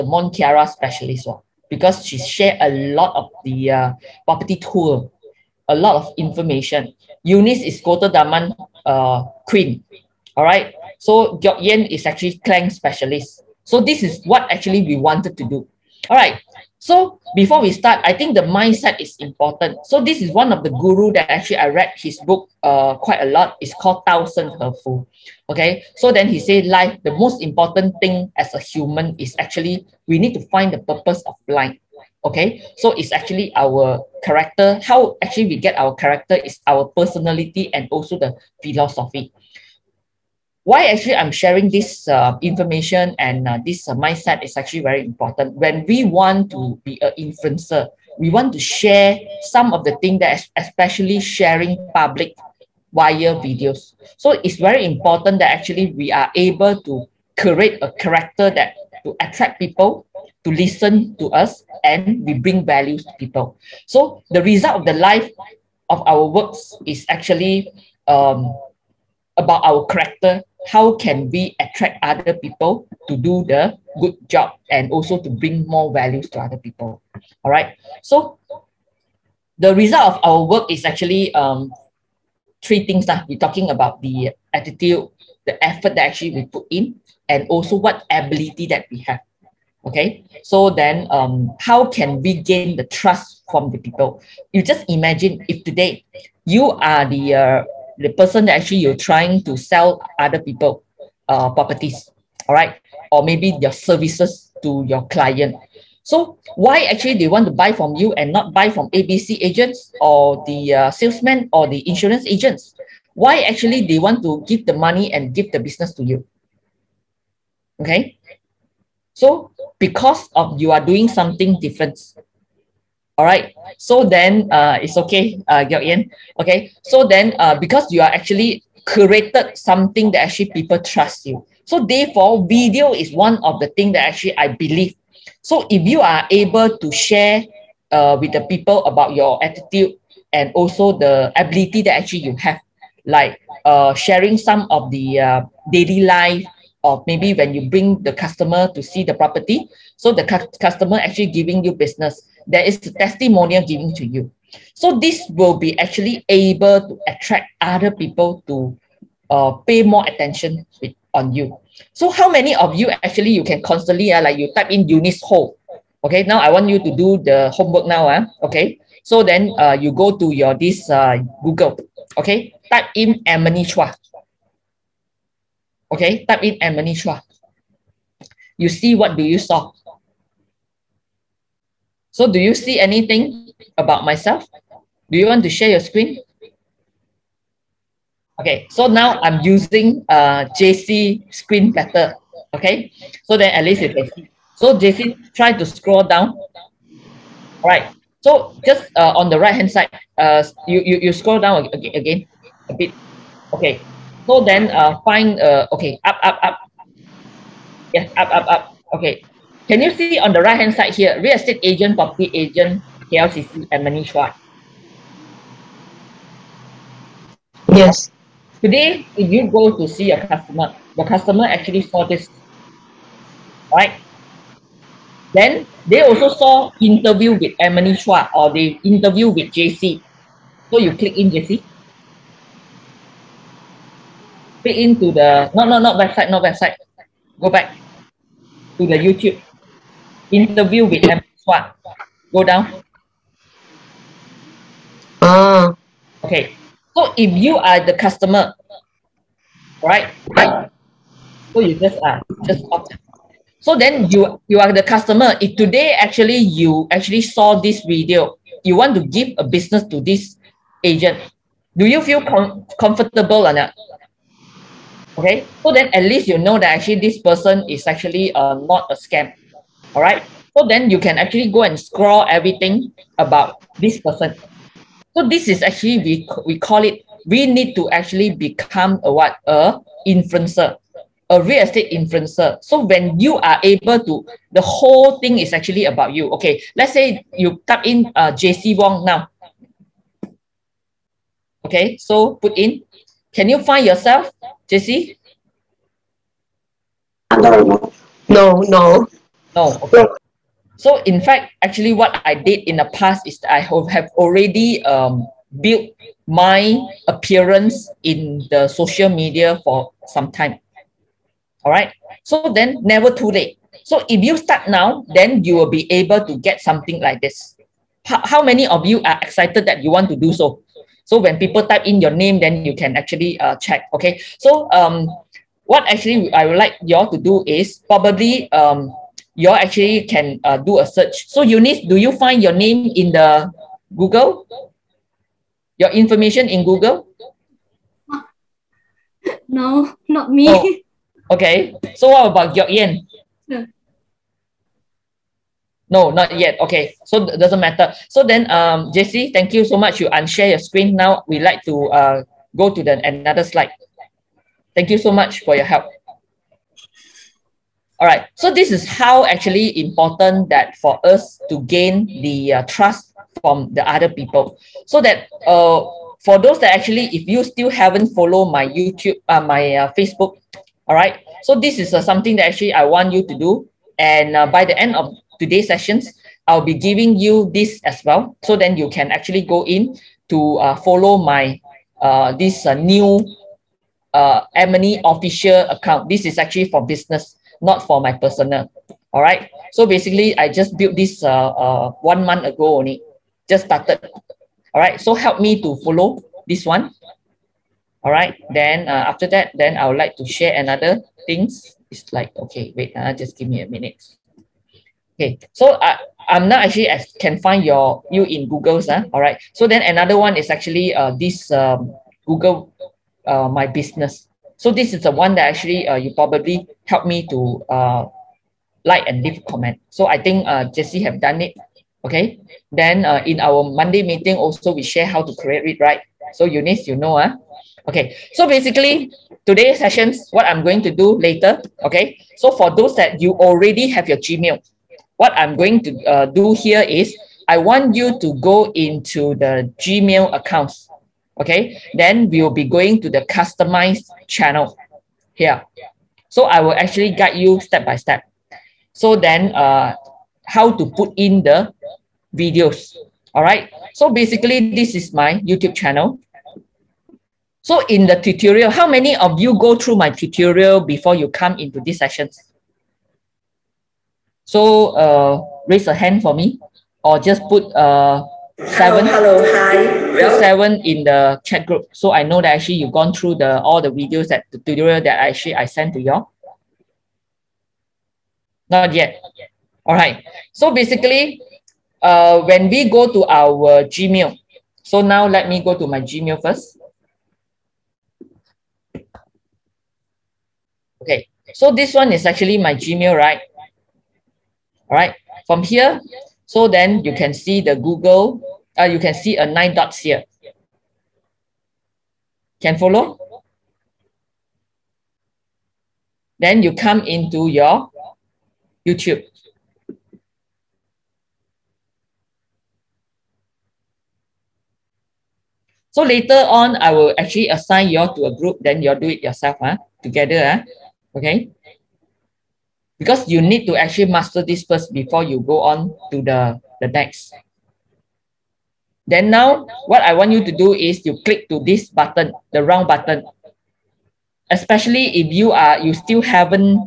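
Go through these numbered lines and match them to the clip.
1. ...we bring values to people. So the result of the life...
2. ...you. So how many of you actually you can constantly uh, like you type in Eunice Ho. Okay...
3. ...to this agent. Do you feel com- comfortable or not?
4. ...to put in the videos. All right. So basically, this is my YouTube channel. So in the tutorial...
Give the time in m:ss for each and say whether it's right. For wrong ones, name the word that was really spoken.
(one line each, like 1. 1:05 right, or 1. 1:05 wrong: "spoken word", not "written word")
1. 1:02 right
2. 2:41 right
3. 4:19 right
4. 7:30 right.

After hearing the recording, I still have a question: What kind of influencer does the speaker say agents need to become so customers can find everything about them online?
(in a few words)
Real estate influencer.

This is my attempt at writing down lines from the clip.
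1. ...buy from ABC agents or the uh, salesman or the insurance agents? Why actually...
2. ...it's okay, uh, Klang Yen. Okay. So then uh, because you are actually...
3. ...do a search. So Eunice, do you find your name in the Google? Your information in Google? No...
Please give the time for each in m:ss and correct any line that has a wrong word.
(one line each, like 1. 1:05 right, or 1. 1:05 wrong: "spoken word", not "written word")
1. 1:48 right
2. 2:04 wrong: "Gyeok", not "Klang"
3. 5:30 right.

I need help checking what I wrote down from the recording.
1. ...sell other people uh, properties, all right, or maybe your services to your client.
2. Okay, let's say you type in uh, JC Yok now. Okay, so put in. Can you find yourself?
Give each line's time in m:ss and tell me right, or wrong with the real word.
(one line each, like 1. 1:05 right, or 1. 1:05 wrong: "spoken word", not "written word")
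1. 1:39 right
2. 4:46 wrong: "Wong", not "Yok".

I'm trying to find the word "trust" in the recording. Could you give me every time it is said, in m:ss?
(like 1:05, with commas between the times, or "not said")
1:32, 2:10, 6:02.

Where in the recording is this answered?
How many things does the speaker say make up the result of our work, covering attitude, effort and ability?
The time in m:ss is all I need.
1:22.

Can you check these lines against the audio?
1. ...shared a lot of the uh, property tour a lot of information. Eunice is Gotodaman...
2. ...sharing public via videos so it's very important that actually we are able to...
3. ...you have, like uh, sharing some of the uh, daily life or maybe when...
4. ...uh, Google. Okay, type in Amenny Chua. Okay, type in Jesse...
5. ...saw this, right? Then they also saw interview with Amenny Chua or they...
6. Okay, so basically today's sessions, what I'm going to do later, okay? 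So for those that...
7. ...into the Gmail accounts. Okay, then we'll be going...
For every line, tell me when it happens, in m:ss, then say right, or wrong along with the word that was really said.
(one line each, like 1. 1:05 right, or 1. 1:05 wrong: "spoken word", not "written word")
1. 0:02 right
2. 0:51 right
3. 2:22 right
4. 2:50 wrong: "Amenny", not "Jesse"
5. 3:41 right
6. 7:07 right
7. 7:18 right.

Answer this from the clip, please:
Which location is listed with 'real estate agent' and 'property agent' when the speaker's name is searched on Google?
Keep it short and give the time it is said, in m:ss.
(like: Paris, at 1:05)
KLCC, at 3:33.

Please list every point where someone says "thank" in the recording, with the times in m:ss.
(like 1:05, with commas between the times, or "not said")
5:49, 5:54.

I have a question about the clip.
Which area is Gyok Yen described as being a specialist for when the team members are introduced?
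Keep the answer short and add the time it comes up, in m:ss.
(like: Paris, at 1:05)
Klang, at 0:12.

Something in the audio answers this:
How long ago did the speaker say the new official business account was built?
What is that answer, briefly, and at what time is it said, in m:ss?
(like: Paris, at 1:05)
One month ago, at 6:32.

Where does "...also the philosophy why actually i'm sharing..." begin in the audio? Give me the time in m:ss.
0:37.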